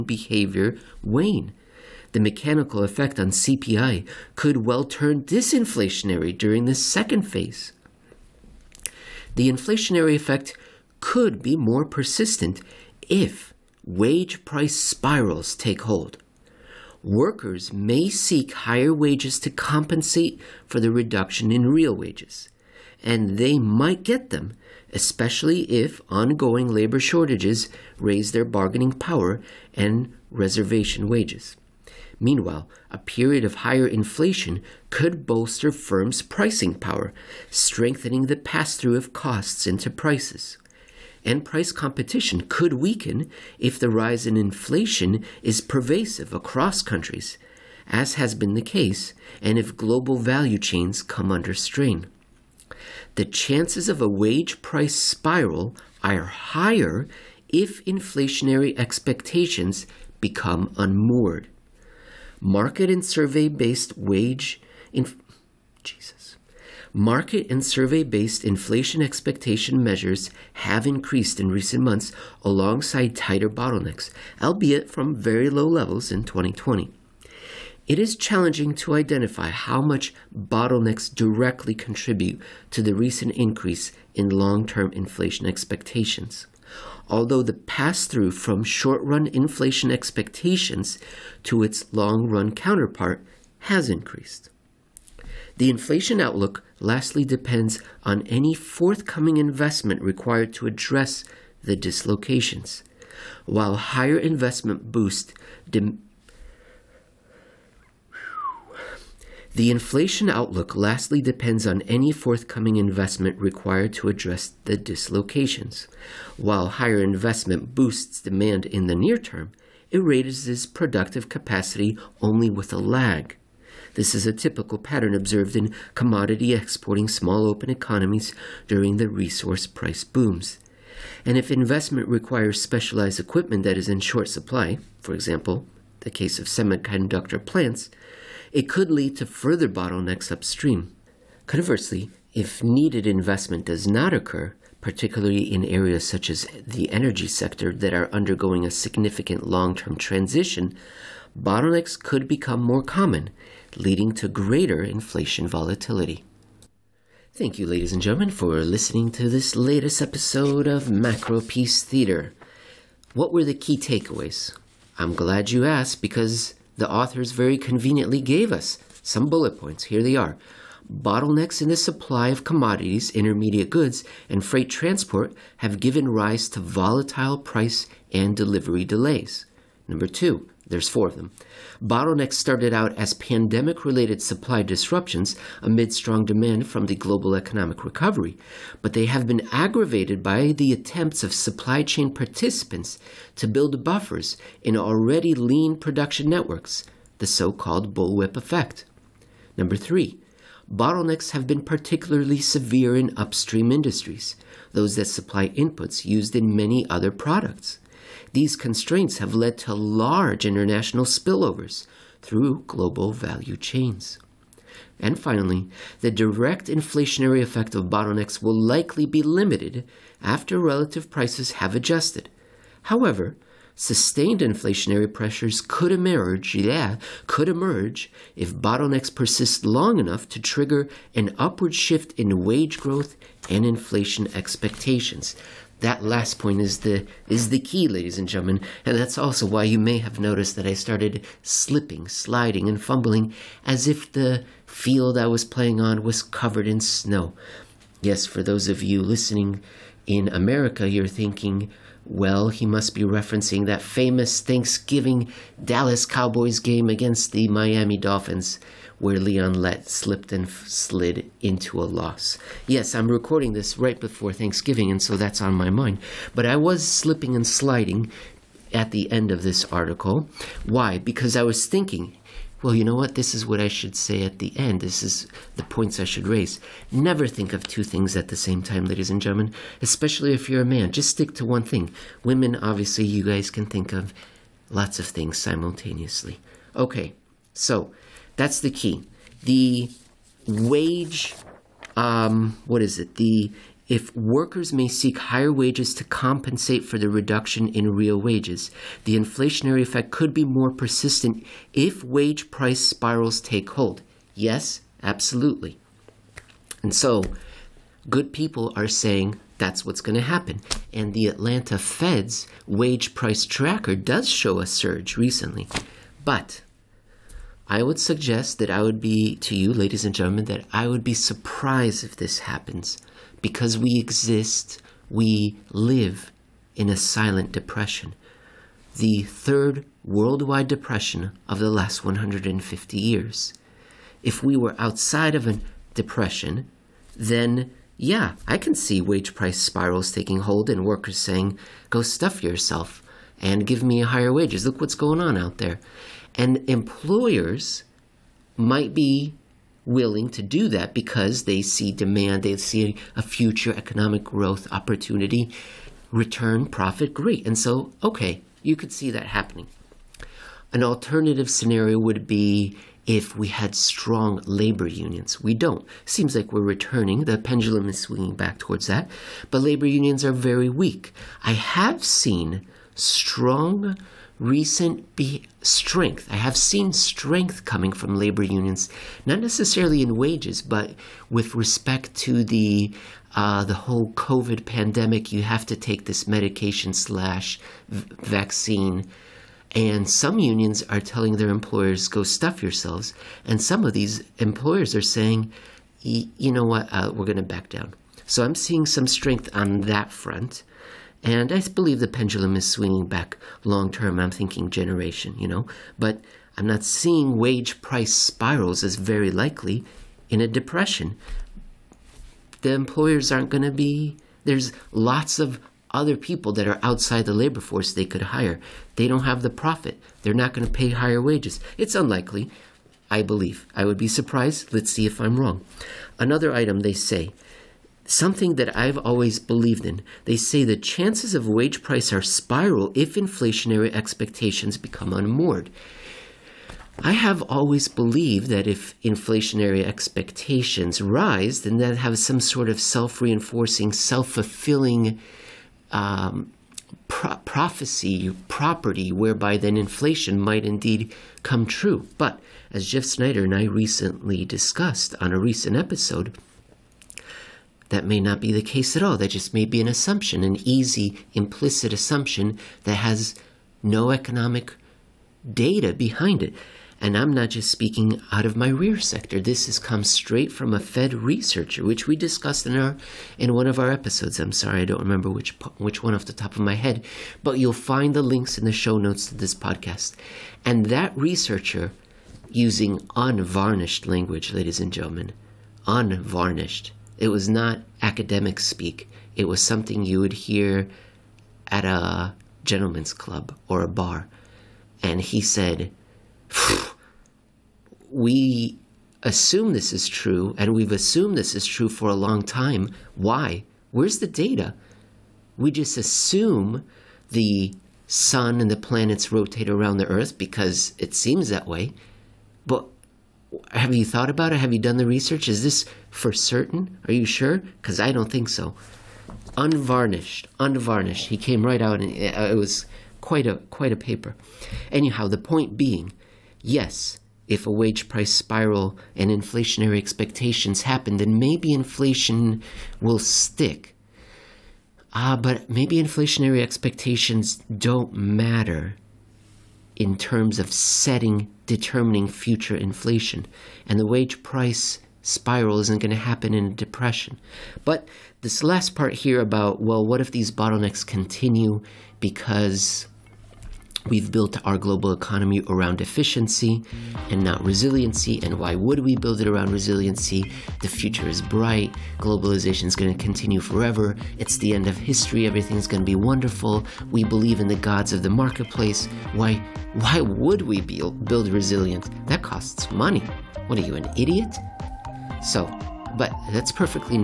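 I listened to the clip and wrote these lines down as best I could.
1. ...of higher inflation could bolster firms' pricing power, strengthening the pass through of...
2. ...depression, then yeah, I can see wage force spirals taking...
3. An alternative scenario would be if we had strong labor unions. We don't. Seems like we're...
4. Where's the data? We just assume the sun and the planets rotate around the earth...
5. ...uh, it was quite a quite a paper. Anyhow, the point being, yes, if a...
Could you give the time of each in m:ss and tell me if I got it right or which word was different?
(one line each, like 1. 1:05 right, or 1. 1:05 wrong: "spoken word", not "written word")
1. 0:33 right
2. 5:35 wrong: "price", not "force"
3. 6:00 right
4. 8:23 right
5. 8:42 right.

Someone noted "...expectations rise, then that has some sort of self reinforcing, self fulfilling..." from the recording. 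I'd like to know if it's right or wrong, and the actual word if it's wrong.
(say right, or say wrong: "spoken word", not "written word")
right.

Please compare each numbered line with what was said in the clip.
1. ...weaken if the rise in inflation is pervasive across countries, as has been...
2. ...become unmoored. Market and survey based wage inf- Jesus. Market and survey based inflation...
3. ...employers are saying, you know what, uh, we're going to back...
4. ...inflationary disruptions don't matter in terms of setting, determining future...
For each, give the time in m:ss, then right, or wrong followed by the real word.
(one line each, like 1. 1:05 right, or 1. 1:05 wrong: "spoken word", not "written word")
1. 0:42 right
2. 1:00 right
3. 6:34 right
4. 8:56 wrong: "expectations", not "disruptions".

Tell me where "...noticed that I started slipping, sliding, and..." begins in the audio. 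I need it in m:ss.
4:00.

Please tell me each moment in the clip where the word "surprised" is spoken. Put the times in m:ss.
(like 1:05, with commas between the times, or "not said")
5:21, 7:04.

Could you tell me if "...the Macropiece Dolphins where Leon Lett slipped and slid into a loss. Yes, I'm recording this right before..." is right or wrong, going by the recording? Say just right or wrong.
wrong.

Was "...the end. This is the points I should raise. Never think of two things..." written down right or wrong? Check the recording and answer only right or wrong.
right.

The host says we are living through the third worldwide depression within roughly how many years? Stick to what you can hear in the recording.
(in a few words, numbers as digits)
150.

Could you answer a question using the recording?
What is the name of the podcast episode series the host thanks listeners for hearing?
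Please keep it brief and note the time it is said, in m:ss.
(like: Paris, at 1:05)
Macropiece Theater, at 2:40.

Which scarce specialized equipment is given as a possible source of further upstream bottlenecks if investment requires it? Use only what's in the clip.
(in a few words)
semiconductor plants.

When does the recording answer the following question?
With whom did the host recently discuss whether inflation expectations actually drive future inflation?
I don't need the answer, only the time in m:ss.
7:32.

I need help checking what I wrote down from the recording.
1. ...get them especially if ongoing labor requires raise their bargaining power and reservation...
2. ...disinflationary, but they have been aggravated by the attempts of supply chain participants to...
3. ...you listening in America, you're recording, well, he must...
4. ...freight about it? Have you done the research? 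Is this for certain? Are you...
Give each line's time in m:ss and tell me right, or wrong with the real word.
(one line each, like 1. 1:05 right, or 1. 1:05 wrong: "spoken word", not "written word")
1. 0:24 wrong: "shortages", not "requires"
2. 3:07 wrong: "recovery", not "disinflationary"
3. 4:08 wrong: "thinking", not "recording"
4. 8:34 wrong: "thought", not "freight".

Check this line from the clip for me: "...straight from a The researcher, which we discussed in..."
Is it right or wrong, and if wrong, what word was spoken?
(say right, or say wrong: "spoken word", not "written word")
wrong: "Fed", not "The".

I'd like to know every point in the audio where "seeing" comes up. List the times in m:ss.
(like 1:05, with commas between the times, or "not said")
6:38, 6:46.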